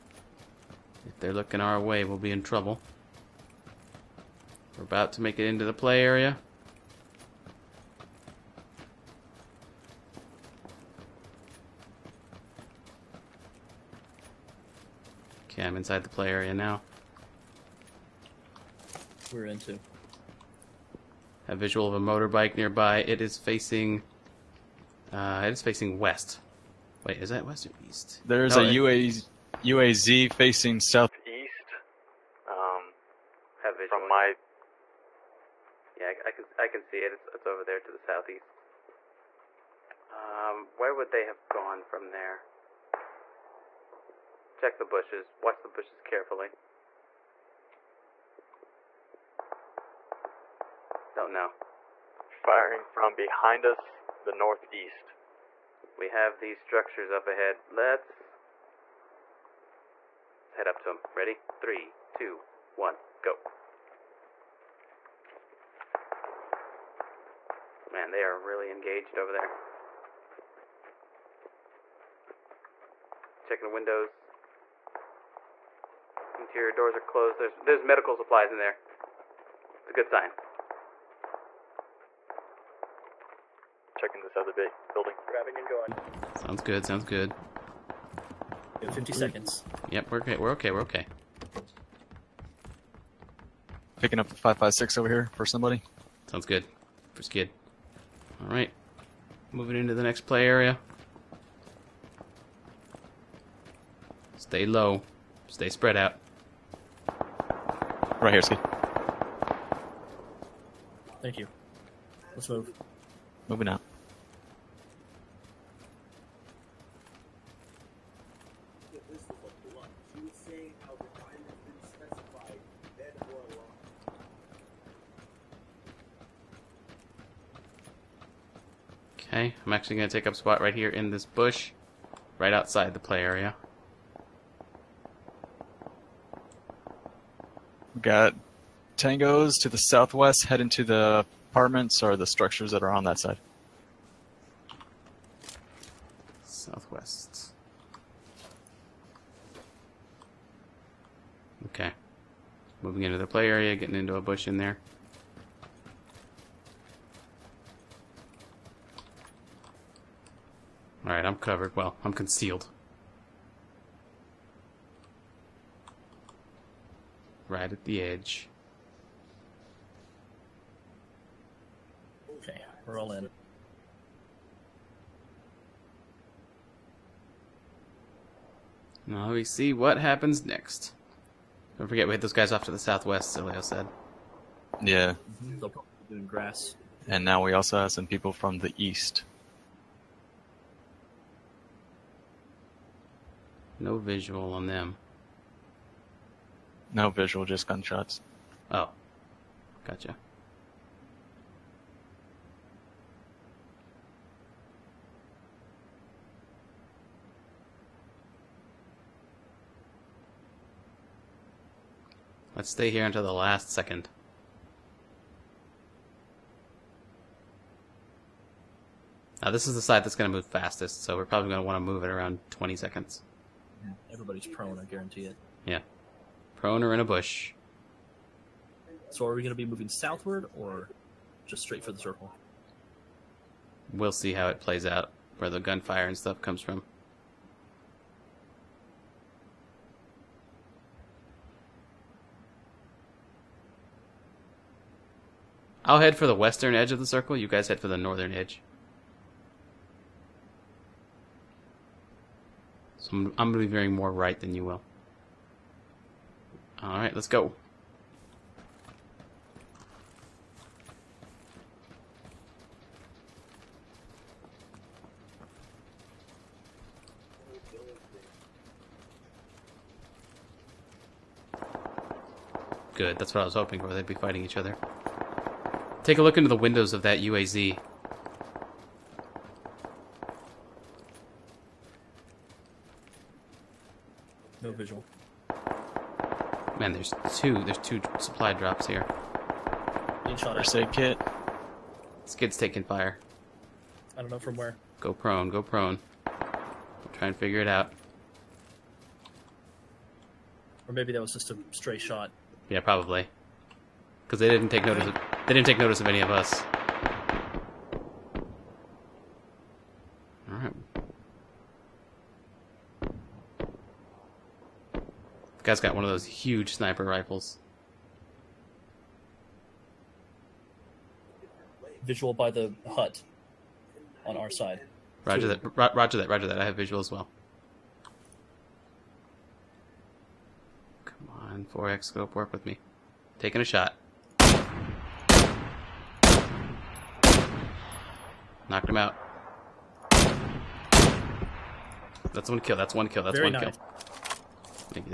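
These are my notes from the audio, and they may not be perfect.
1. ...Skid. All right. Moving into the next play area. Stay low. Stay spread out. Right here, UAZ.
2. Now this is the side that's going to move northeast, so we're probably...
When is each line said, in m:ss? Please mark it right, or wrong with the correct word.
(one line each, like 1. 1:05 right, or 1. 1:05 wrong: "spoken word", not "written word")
1. 1:37 wrong: "Ski", not "UAZ"
2. 3:39 wrong: "fastest", not "northeast".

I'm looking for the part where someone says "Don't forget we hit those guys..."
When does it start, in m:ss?
3:01.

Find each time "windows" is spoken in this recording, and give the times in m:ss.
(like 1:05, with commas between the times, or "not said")
1:13, 4:36.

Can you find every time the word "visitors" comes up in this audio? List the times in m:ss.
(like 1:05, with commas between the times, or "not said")
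not said.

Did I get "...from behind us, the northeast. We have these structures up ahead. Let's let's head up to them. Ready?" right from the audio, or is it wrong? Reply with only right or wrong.
right.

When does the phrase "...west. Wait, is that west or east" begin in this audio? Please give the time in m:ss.
0:25.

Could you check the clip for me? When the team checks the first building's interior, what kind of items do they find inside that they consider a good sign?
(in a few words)
Medical supplies.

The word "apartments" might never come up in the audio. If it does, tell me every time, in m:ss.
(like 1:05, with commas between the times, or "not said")
2:21.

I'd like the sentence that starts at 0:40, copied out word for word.
Um, where would they have gone from there?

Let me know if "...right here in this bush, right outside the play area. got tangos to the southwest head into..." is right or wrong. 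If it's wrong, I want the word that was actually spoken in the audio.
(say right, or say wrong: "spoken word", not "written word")
right.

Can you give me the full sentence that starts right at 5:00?
Or maybe that was just a stray shot.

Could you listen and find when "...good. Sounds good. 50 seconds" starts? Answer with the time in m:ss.
1:26.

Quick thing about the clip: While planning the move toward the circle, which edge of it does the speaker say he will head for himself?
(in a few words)
Western edge.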